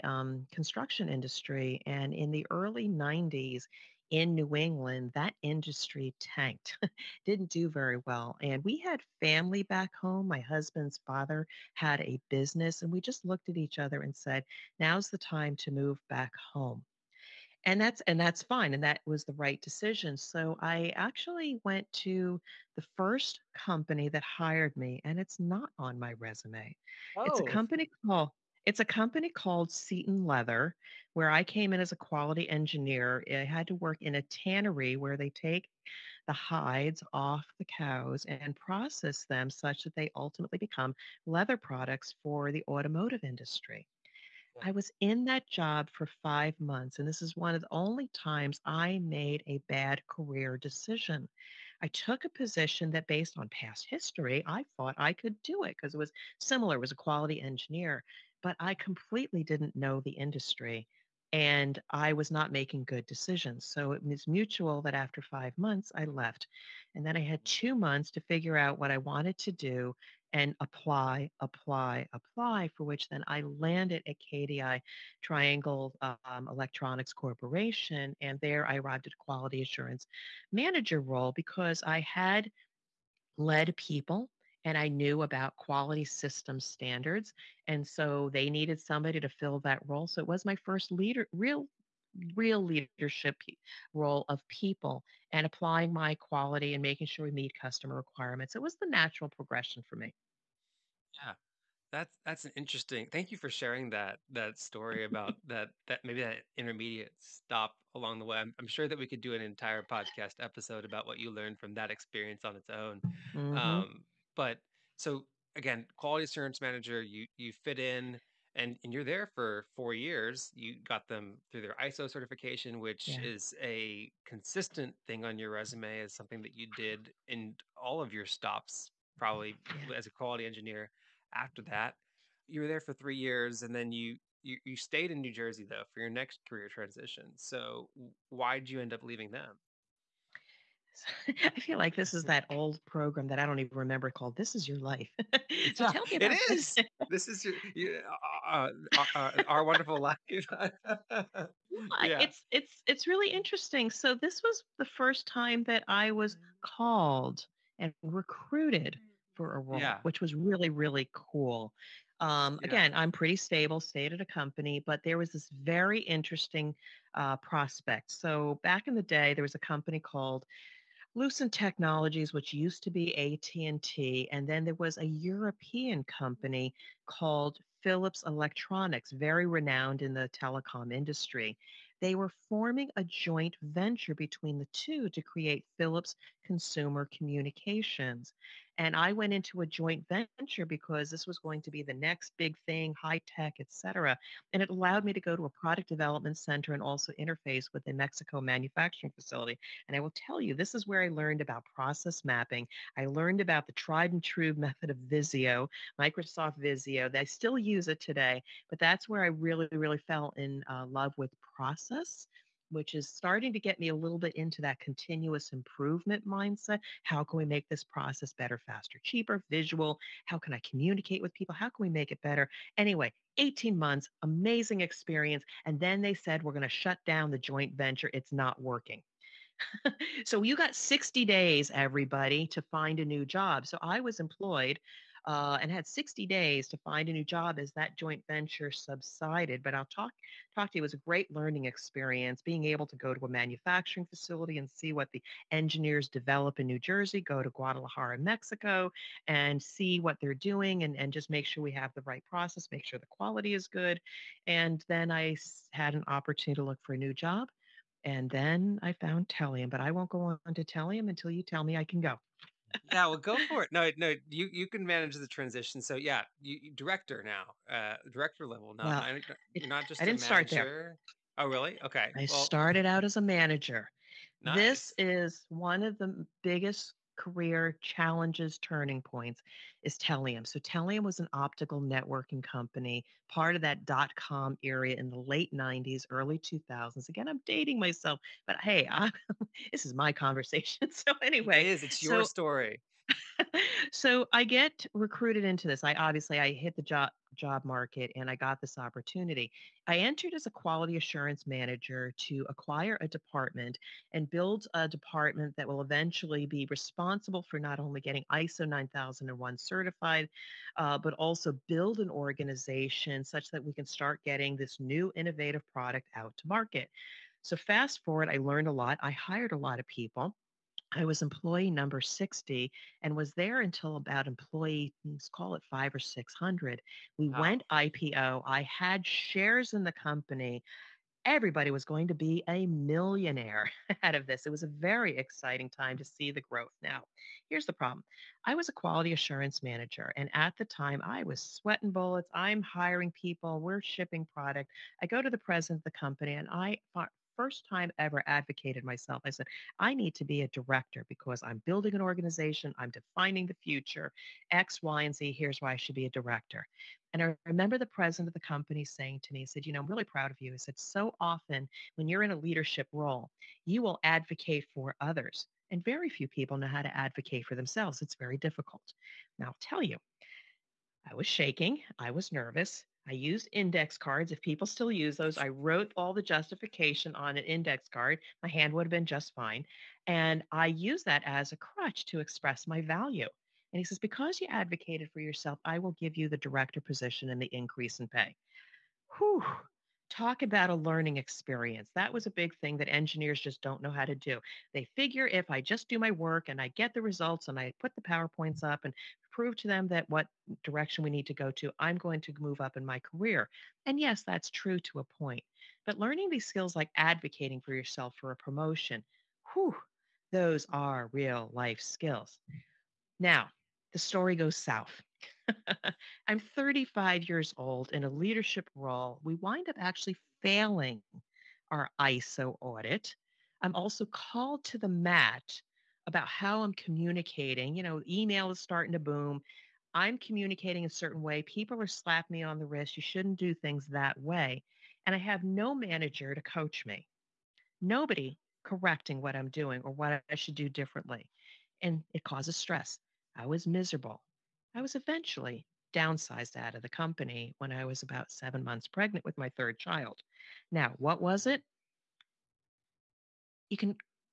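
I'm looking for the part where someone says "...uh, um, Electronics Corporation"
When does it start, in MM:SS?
01:16.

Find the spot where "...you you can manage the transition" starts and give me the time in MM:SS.
04:24.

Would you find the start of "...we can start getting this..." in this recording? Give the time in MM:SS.
05:13.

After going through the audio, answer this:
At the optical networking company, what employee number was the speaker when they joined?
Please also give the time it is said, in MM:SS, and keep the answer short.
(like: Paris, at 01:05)
60, at 05:21.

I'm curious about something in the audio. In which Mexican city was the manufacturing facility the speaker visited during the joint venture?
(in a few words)
Guadalajara.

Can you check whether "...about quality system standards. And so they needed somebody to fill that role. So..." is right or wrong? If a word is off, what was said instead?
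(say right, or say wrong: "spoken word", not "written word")
right.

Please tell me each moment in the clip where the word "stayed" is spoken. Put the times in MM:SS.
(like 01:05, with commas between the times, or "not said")
02:14, 02:43.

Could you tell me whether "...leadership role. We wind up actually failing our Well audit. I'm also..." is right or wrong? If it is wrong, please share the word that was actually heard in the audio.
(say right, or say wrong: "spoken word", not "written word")
wrong: "ISO", not "Well".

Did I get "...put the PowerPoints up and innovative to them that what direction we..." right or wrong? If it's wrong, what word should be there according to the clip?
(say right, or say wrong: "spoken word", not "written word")
wrong: "prove", not "innovative".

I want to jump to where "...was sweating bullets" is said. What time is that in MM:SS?
05:41.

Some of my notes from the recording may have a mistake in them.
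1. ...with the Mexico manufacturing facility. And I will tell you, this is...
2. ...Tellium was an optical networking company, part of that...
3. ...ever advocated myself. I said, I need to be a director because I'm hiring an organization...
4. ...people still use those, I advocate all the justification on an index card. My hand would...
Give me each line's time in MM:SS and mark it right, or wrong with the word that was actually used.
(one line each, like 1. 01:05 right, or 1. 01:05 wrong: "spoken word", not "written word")
1. 03:17 right
2. 04:40 right
3. 05:48 wrong: "building", not "hiring"
4. 06:14 wrong: "wrote", not "advocate".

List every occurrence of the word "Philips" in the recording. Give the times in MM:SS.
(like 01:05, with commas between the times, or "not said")
02:57, 03:05.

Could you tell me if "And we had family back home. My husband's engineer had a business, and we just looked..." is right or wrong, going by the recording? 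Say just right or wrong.
wrong.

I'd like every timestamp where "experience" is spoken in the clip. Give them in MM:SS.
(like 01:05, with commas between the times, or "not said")
01:51, 03:44, 04:01, 06:31.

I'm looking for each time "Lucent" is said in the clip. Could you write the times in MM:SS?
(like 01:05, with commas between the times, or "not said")
02:51.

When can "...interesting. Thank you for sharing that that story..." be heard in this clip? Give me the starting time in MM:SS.
01:42.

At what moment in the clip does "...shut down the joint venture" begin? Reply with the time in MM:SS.
03:46.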